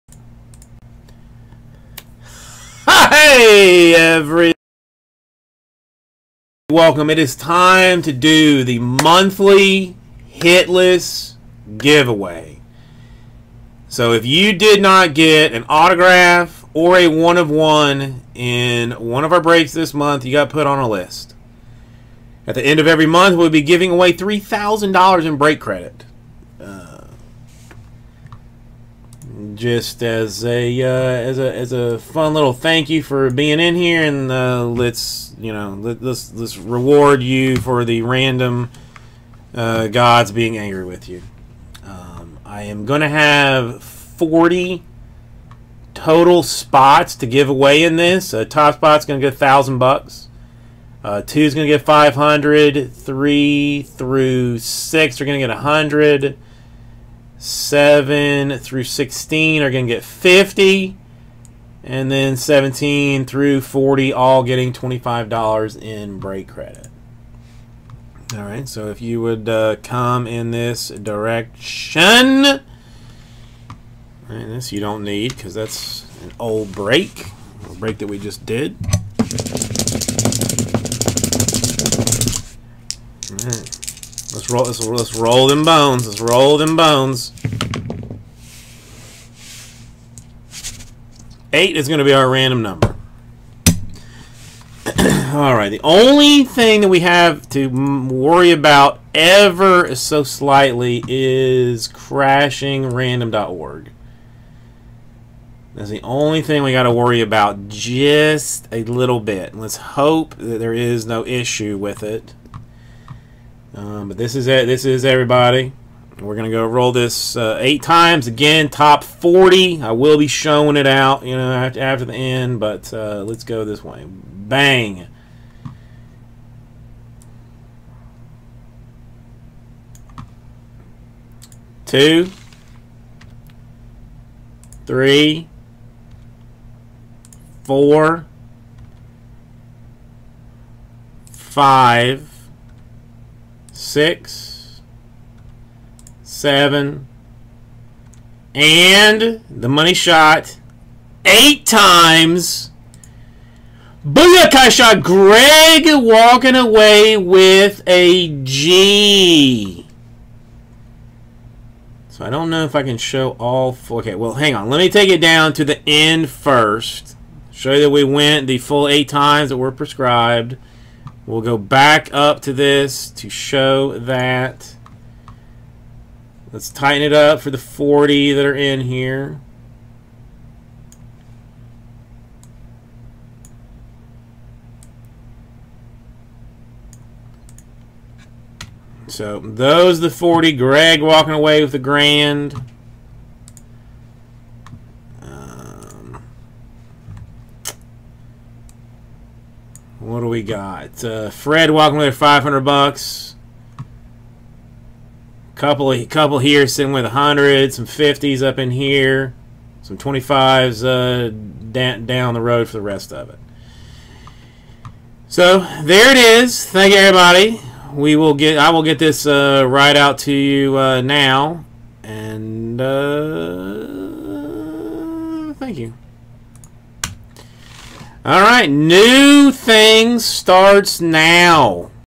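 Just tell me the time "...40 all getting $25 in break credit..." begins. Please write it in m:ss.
1:03.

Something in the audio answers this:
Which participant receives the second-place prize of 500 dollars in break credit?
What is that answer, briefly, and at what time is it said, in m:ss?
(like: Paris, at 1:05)
Fred, at 3:21.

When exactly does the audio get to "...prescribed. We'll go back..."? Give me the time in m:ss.
2:49.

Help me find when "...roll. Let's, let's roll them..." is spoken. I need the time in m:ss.
1:24.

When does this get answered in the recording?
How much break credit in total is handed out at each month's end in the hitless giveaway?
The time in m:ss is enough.
0:24.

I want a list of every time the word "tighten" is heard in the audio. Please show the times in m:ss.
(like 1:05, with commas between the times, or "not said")
2:56.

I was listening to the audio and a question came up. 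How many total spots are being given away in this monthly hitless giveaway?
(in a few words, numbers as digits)
40.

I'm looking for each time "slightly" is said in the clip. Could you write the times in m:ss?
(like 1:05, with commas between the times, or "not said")
1:40.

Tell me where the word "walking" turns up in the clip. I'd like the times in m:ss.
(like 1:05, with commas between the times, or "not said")
2:35, 3:11.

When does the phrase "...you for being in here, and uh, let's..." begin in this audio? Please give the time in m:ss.
0:32.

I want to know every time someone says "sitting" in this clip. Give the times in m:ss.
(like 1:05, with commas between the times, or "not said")
3:26.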